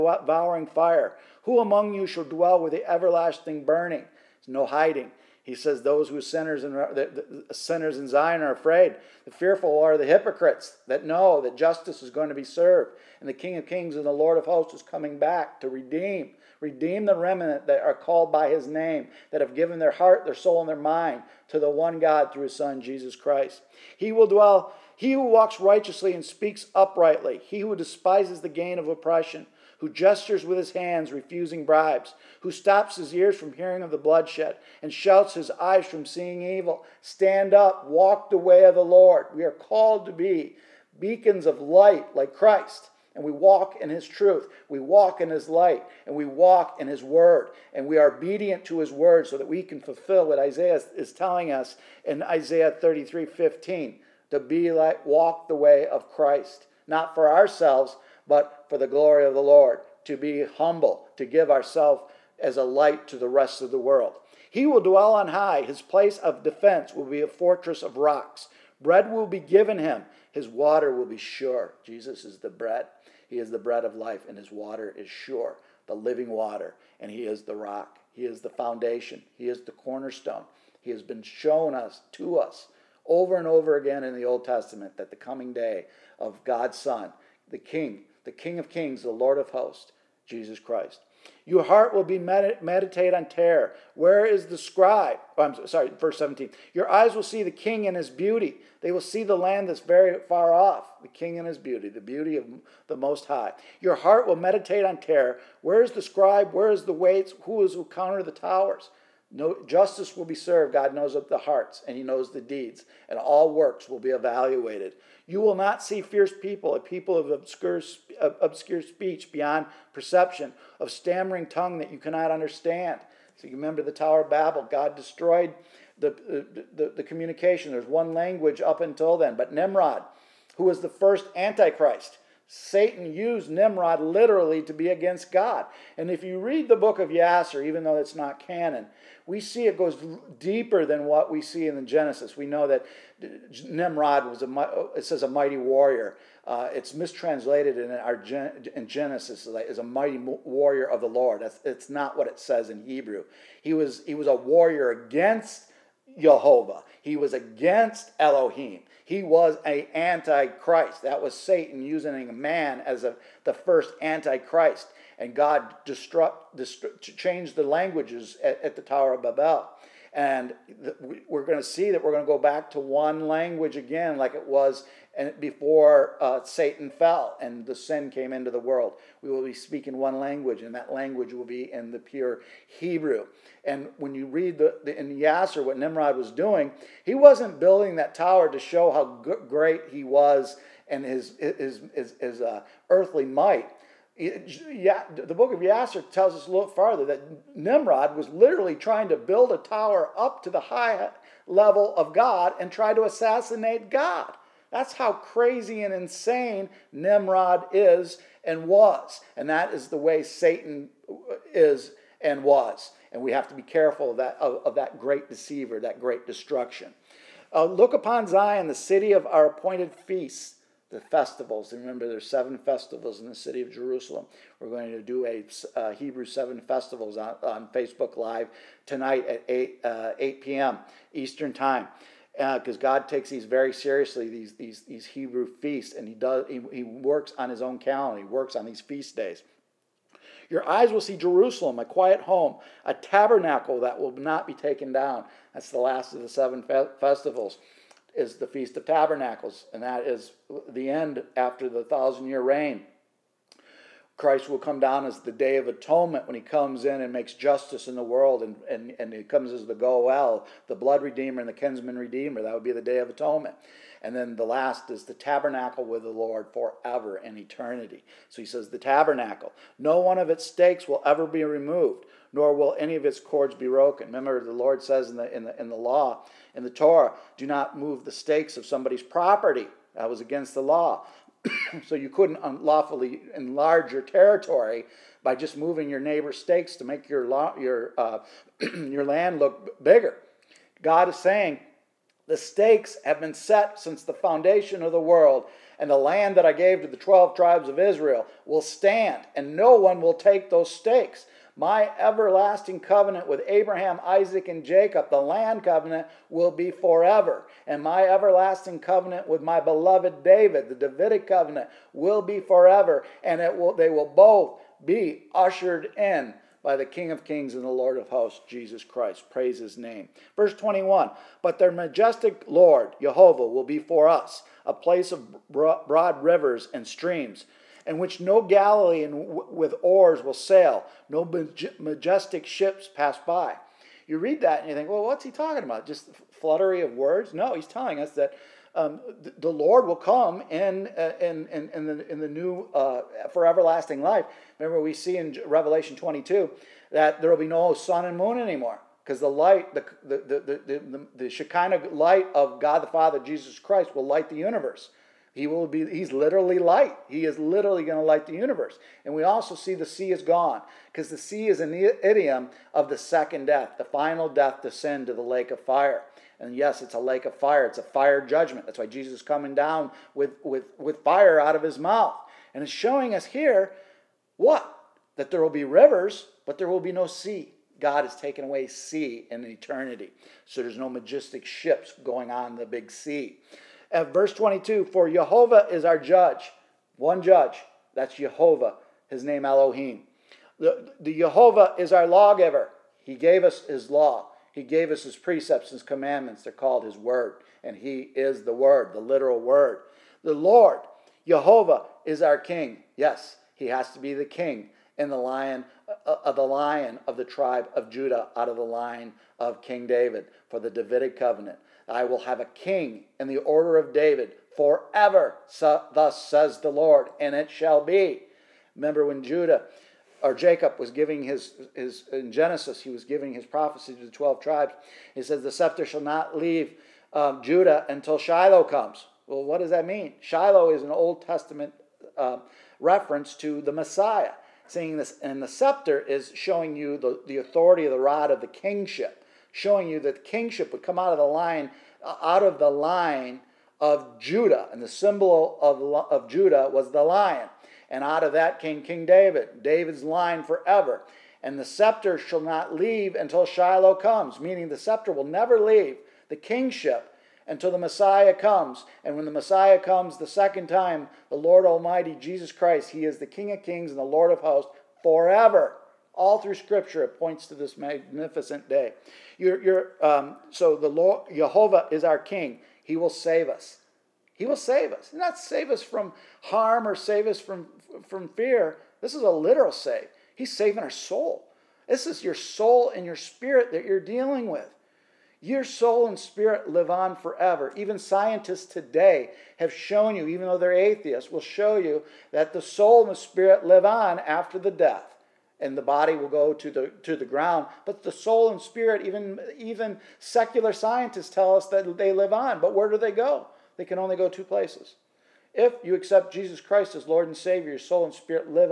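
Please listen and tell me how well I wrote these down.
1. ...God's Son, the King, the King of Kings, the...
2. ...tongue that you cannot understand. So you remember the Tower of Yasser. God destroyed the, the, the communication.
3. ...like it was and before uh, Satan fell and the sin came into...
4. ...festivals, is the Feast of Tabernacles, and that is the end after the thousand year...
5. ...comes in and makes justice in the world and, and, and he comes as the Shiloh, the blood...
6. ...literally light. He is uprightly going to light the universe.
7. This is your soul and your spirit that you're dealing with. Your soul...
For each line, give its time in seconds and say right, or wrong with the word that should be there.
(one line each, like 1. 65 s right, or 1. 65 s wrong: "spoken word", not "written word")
1. 86 s right
2. 121 s wrong: "Babel", not "Yasser"
3. 174 s right
4. 246 s right
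5. 256 s wrong: "Goel", not "Shiloh"
6. 356 s wrong: "literally", not "uprightly"
7. 481 s right.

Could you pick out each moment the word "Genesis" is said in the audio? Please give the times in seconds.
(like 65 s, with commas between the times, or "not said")
141 s, 148 s, 422 s.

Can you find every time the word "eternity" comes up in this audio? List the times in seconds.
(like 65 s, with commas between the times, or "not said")
267 s, 379 s.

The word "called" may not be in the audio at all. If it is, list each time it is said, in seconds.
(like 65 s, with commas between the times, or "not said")
17 s, 39 s, 396 s.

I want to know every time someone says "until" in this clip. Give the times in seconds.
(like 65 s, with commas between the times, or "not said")
128 s, 427 s, 453 s, 457 s.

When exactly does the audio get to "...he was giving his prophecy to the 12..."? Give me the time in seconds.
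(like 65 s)
422 s.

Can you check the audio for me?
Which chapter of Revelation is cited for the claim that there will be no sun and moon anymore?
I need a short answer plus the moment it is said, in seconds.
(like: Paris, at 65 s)
Revelation 22, at 345 s.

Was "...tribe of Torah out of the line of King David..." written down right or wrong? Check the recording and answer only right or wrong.
wrong.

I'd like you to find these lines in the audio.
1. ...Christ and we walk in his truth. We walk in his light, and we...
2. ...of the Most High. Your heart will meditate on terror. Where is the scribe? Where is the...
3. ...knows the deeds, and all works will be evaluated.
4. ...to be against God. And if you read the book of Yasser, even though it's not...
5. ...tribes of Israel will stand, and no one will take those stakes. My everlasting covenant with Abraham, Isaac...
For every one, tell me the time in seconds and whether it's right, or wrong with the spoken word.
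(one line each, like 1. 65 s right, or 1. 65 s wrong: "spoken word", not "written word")
1. 42 s right
2. 102 s right
3. 112 s right
4. 134 s right
5. 297 s right.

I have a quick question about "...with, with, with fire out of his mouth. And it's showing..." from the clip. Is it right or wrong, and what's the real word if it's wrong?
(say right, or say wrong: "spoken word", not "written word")
right.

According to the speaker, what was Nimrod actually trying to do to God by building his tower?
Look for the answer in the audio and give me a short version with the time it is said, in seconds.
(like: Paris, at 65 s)
assassinate God, at 203 s.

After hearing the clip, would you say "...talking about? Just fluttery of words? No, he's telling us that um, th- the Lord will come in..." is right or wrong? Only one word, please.
right.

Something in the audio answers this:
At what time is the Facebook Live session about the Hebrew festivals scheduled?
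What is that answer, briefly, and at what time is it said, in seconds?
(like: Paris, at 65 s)
8 p.m. Eastern, at 230 s.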